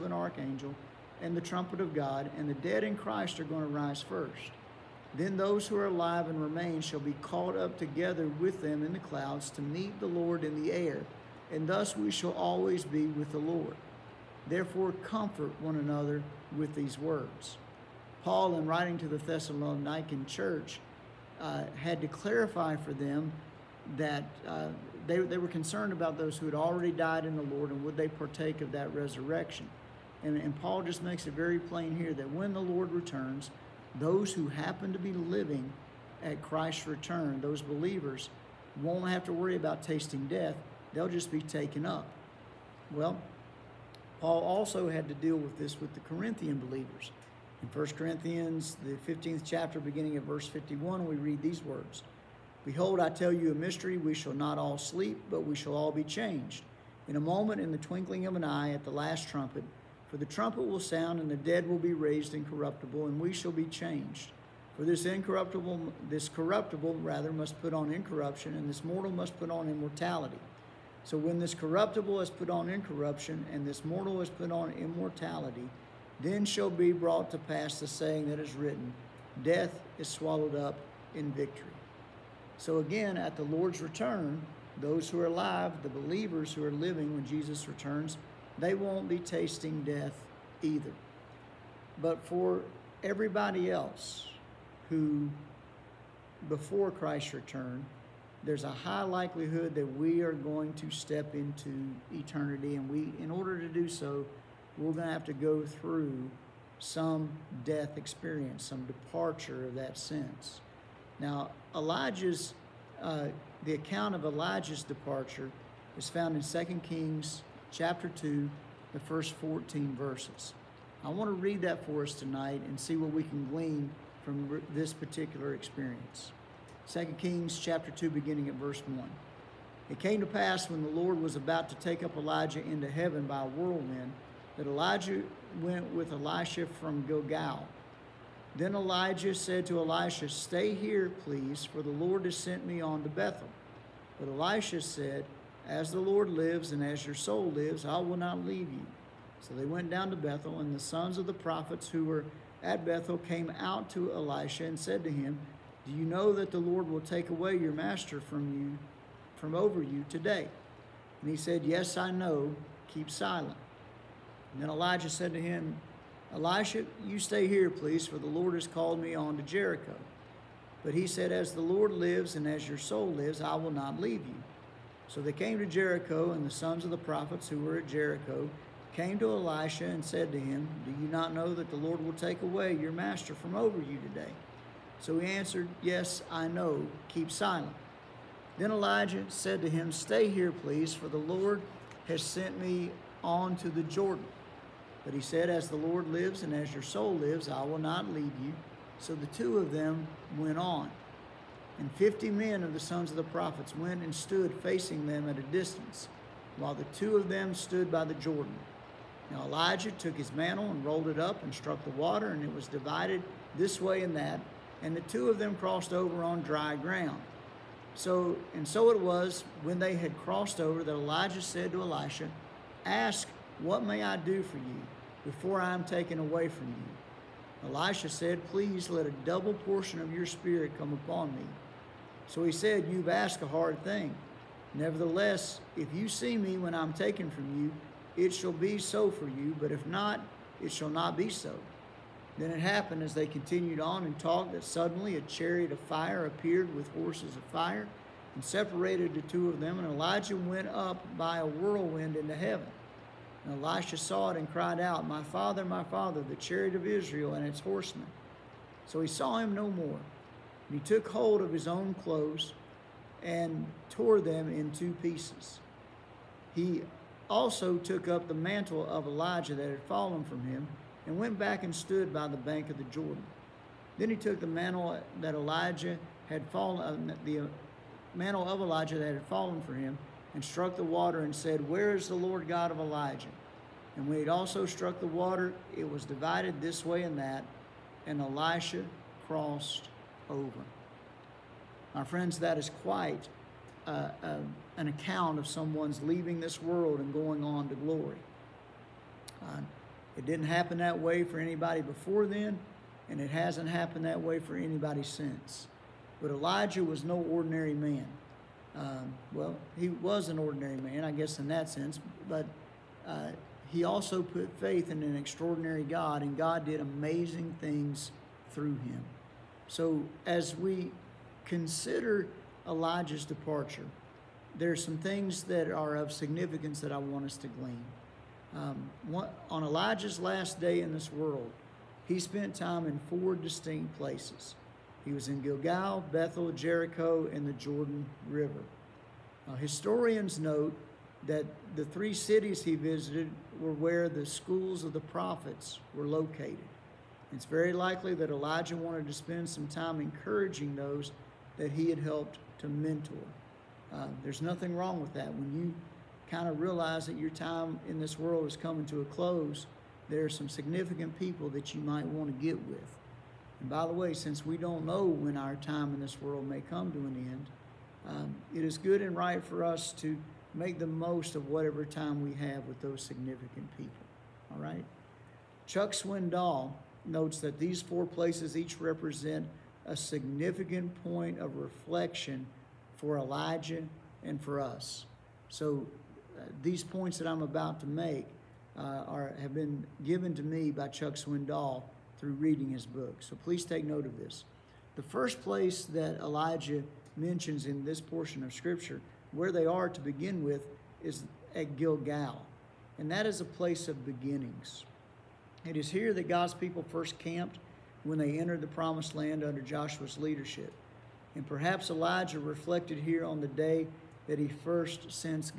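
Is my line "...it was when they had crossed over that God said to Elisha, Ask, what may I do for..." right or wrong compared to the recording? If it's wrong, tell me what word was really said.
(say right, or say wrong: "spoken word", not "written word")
wrong: "Elijah", not "God".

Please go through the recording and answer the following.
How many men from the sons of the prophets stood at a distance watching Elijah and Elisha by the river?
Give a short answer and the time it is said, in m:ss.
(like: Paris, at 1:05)
50, at 3:21.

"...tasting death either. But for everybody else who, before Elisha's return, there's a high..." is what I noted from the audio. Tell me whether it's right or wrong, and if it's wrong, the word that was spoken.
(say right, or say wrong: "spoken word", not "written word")
wrong: "Christ", not "Elisha".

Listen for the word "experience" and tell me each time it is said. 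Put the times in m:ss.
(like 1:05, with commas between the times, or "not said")
1:47, 2:05.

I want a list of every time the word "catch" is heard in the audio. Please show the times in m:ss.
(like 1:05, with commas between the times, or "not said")
not said.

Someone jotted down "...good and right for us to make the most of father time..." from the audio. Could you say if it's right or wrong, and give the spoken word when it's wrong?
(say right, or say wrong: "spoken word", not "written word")
wrong: "whatever", not "father".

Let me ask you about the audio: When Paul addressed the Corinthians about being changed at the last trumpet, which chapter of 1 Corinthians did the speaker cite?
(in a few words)
15th chapter.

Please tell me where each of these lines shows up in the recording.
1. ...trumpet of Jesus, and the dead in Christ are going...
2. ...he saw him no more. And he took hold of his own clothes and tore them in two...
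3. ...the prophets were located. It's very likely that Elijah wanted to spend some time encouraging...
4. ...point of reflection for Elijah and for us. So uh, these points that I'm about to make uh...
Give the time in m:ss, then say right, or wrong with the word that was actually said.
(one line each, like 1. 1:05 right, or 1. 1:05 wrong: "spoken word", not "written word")
1. 0:01 wrong: "God", not "Jesus"
2. 4:19 right
3. 5:44 right
4. 6:21 right.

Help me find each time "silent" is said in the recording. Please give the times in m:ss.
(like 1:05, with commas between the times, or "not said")
2:43, 3:07.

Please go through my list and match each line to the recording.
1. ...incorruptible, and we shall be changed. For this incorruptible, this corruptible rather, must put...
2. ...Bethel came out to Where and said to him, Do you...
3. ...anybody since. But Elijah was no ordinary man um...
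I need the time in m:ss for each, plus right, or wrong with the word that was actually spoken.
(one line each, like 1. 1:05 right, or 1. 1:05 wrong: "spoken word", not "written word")
1. 1:02 right
2. 2:32 wrong: "Elisha", not "Where"
3. 5:04 right.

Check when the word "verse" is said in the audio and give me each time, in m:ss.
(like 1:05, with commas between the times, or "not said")
0:50, 1:59, 2:08.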